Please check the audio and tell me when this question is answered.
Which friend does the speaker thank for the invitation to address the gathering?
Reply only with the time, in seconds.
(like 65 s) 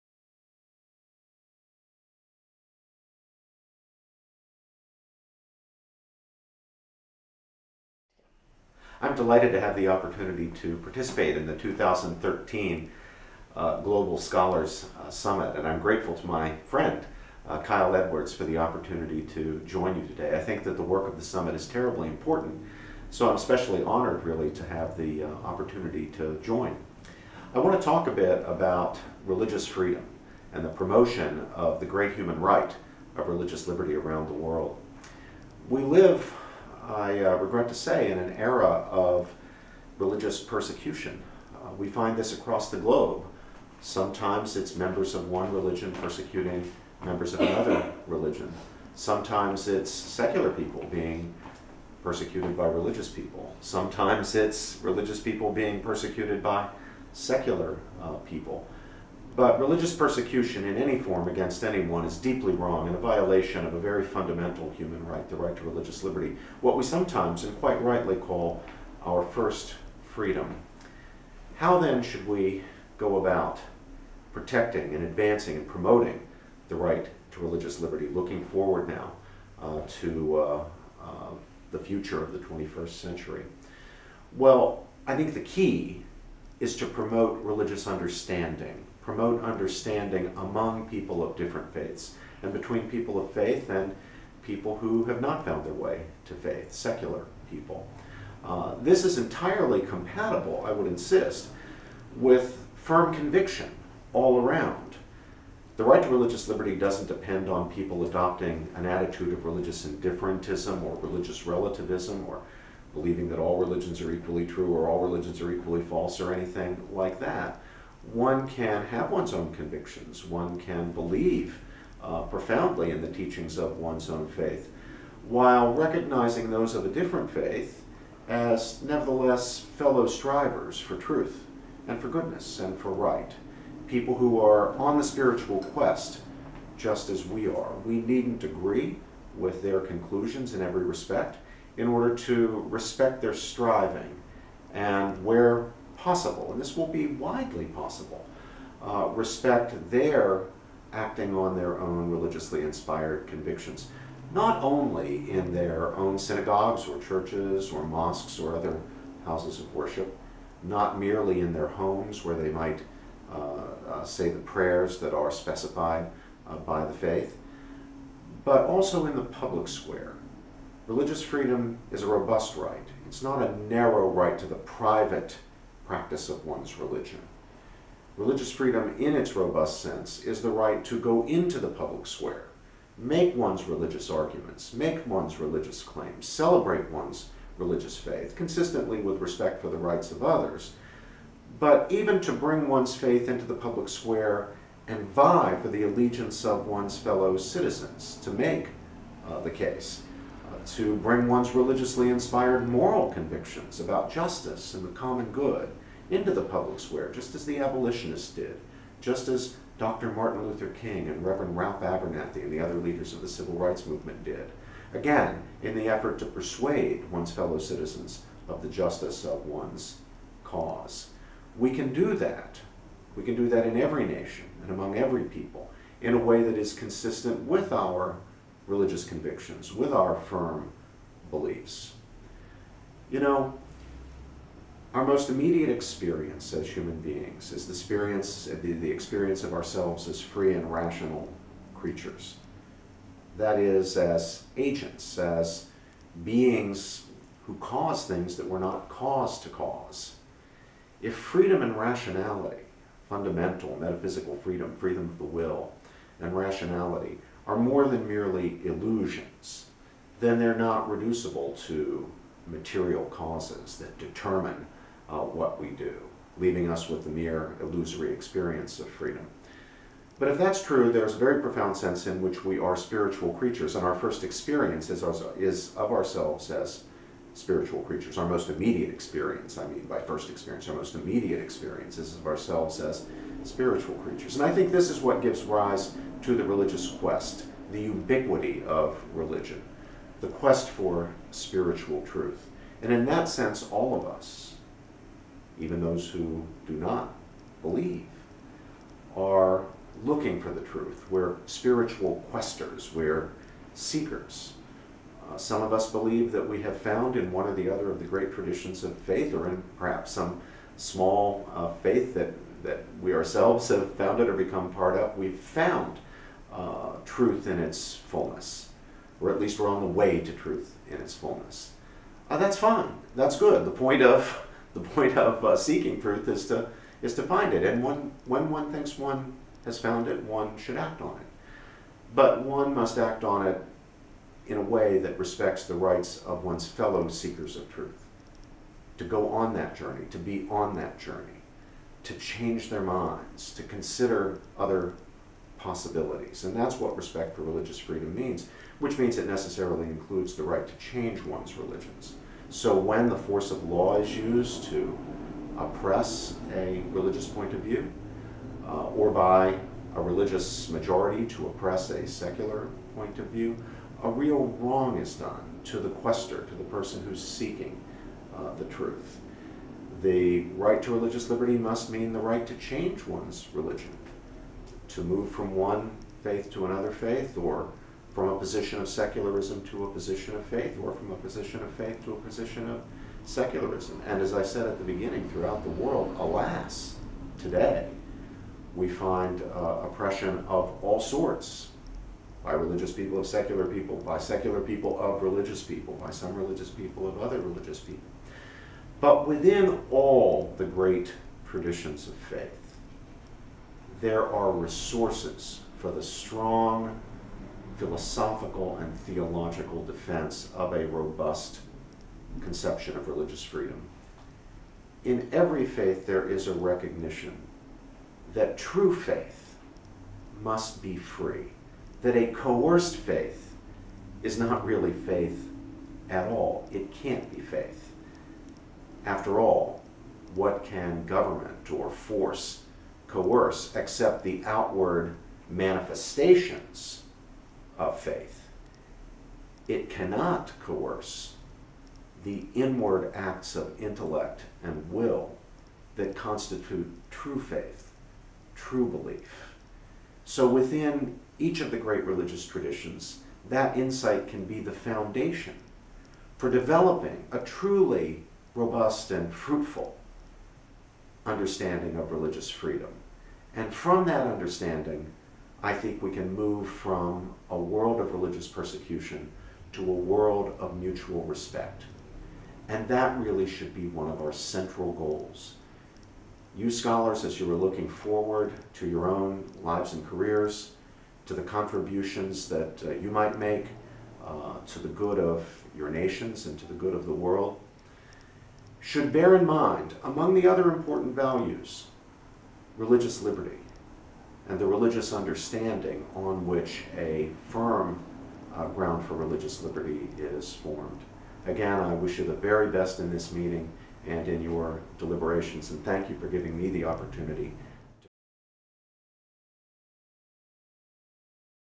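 17 s.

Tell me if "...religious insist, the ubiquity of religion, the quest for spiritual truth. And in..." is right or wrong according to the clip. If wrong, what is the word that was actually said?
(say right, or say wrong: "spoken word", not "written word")
wrong: "quest", not "insist".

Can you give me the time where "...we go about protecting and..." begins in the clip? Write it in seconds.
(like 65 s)
72 s.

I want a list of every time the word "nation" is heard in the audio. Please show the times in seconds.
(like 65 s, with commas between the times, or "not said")
224 s, 485 s.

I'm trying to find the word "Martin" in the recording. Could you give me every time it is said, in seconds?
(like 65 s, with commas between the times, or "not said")
210 s.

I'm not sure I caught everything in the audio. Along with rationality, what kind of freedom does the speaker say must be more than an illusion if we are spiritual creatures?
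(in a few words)
freedom of the will.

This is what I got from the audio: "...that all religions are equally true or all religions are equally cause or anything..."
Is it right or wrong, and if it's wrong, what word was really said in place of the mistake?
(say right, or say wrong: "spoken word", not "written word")
wrong: "false", not "cause".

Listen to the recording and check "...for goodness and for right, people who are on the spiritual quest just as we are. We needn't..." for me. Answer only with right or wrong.
right.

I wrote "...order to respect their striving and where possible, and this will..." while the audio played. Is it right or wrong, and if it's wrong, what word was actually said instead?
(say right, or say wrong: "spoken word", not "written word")
right.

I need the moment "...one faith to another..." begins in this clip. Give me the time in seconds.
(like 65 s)
375 s.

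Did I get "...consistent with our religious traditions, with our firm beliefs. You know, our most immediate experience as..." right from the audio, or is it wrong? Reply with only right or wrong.
wrong.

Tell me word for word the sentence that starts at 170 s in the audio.
Religious freedom is a robust right.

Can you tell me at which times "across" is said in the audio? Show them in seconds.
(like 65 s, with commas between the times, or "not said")
42 s.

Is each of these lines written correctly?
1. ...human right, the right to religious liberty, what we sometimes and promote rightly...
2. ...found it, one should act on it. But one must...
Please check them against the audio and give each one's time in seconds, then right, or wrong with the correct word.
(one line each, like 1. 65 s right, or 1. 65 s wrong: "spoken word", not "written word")
1. 64 s wrong: "quite", not "promote"
2. 329 s right.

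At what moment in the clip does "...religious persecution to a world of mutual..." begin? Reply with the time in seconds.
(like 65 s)
468 s.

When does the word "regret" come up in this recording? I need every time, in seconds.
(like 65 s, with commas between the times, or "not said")
37 s.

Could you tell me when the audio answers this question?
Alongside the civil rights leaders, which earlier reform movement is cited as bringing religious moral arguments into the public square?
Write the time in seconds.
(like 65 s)
207 s.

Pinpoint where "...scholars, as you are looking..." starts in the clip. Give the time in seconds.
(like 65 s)
476 s.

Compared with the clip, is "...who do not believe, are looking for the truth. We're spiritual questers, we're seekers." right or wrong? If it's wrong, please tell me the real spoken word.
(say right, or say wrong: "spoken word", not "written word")
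right.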